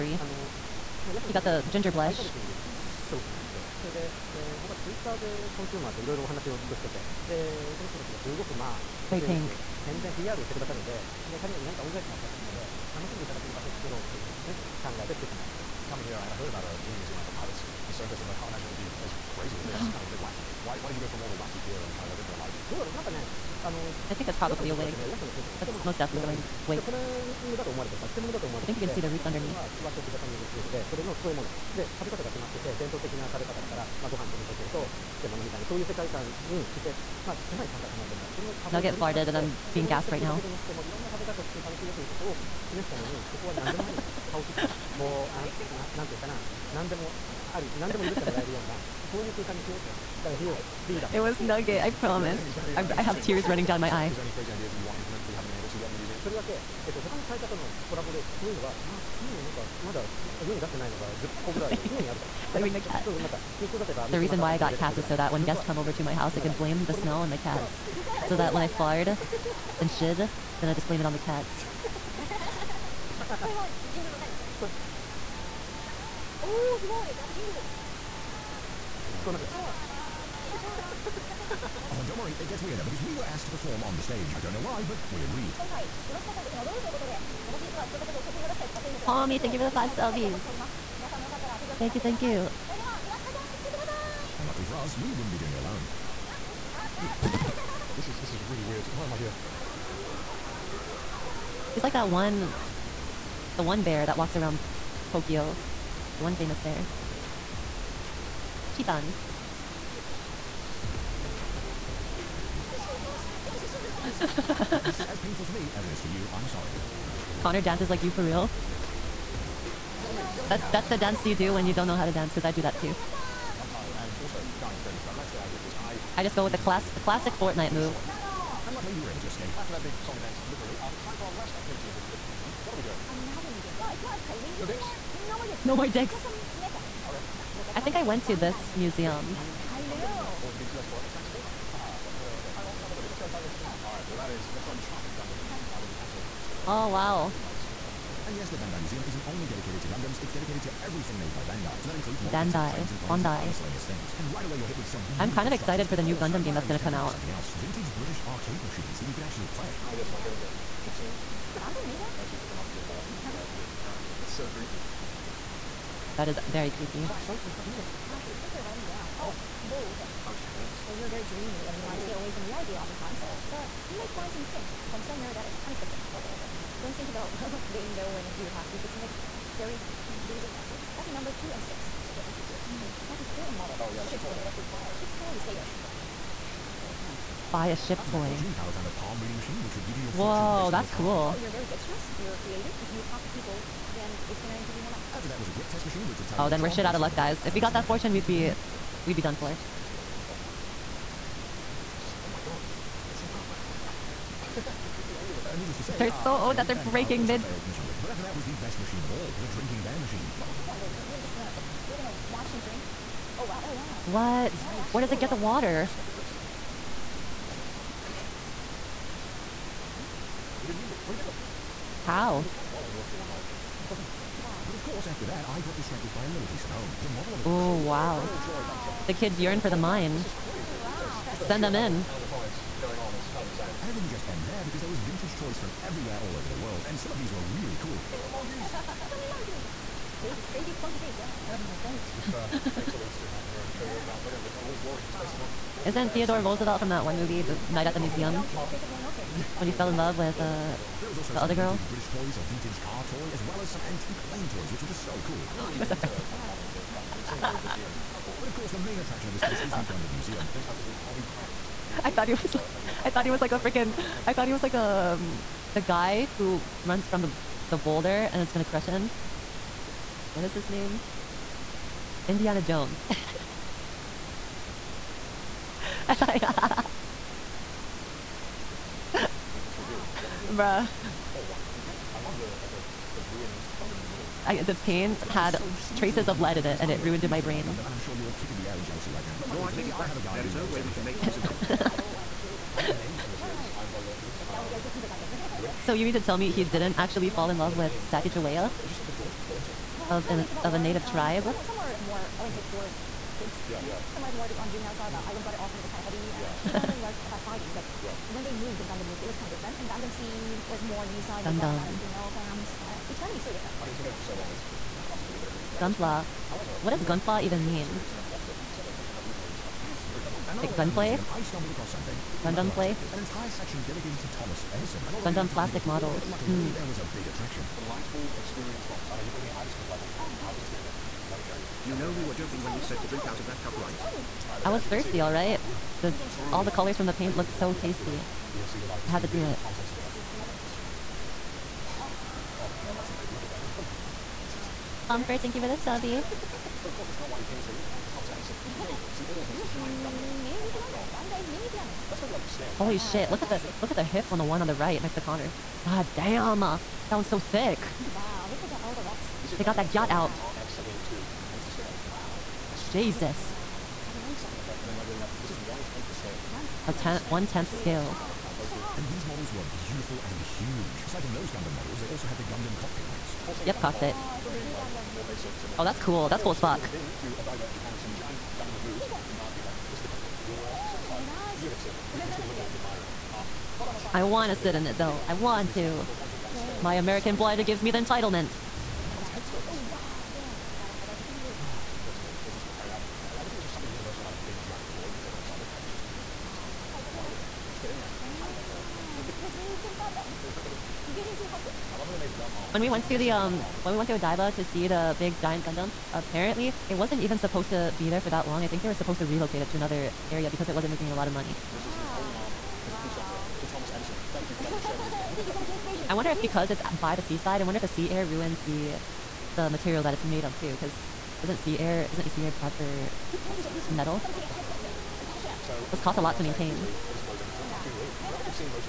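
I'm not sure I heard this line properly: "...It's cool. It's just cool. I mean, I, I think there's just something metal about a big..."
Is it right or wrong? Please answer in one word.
wrong.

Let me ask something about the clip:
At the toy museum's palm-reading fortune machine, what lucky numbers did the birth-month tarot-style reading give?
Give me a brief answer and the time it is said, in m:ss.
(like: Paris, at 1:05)
2 and 6, at 3:00.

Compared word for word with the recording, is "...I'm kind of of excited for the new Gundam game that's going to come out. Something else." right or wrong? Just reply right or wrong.
right.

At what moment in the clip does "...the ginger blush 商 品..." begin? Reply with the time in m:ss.
0:01.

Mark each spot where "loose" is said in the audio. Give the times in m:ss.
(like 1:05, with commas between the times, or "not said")
not said.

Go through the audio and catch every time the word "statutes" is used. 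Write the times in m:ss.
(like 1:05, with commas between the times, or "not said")
not said.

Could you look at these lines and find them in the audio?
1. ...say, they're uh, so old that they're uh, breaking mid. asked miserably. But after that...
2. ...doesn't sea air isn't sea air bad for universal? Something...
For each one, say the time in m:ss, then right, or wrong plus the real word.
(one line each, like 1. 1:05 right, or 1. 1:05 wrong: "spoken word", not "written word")
1. 3:25 wrong: "failed", not "asked"
2. 7:01 wrong: "metal", not "universal".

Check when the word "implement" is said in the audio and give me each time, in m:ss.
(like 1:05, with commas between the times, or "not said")
0:54.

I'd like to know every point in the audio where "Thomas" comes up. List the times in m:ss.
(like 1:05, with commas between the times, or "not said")
5:24, 5:39, 5:48, 6:53.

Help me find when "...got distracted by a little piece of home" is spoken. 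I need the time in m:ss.
3:45.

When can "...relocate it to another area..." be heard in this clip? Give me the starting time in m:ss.
6:49.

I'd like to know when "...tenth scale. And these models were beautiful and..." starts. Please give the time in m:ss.
6:07.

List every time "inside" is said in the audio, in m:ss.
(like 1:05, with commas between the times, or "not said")
2:23, 6:20.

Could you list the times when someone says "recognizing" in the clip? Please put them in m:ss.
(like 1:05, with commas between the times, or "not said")
not said.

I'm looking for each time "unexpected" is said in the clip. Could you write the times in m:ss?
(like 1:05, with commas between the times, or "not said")
2:55, 7:04.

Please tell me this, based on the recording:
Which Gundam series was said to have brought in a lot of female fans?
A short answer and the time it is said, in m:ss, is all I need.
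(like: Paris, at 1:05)
Gundam Seed, at 5:09.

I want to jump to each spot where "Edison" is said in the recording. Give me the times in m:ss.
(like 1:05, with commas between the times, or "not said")
5:24, 5:39, 5:48, 6:53.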